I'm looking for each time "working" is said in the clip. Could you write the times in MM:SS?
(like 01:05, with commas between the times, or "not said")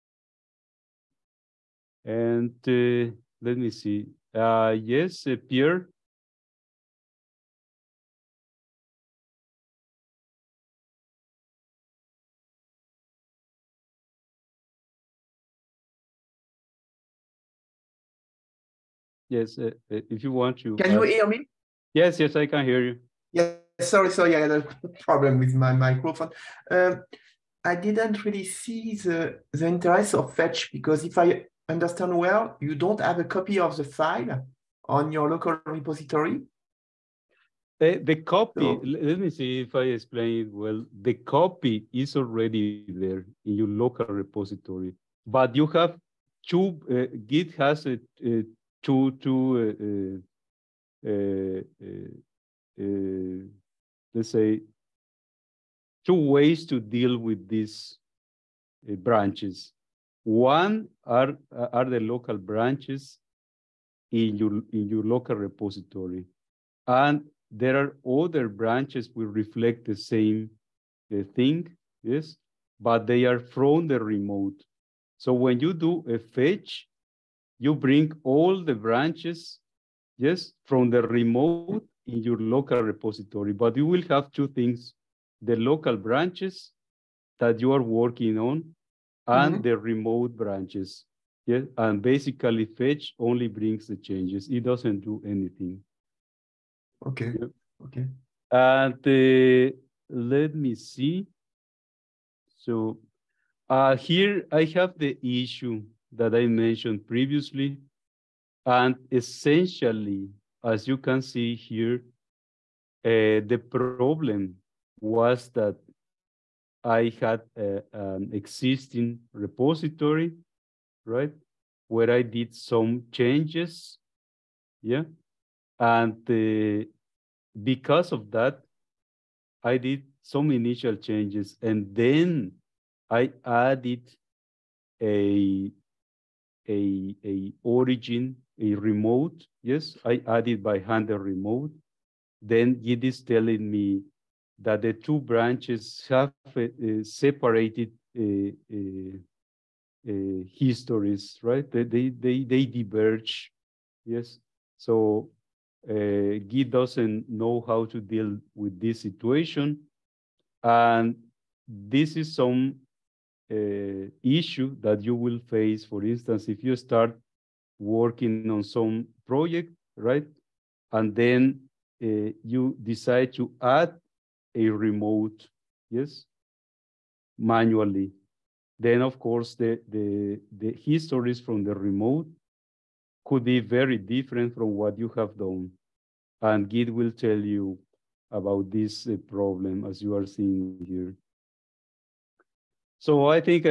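01:27, 02:47.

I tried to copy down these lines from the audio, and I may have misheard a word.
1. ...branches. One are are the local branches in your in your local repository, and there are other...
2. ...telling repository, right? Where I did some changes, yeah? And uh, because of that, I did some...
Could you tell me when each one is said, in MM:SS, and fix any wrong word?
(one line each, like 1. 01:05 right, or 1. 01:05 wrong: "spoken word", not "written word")
1. 00:59 right
2. 01:58 wrong: "existing", not "telling".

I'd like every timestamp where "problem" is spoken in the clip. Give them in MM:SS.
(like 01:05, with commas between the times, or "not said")
00:25, 01:53, 03:09.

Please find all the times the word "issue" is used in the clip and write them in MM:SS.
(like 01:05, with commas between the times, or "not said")
01:45, 02:44.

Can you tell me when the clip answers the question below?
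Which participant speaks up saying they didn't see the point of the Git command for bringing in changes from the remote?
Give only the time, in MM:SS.
00:05.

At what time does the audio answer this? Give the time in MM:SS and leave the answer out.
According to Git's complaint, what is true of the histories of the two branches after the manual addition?
02:27.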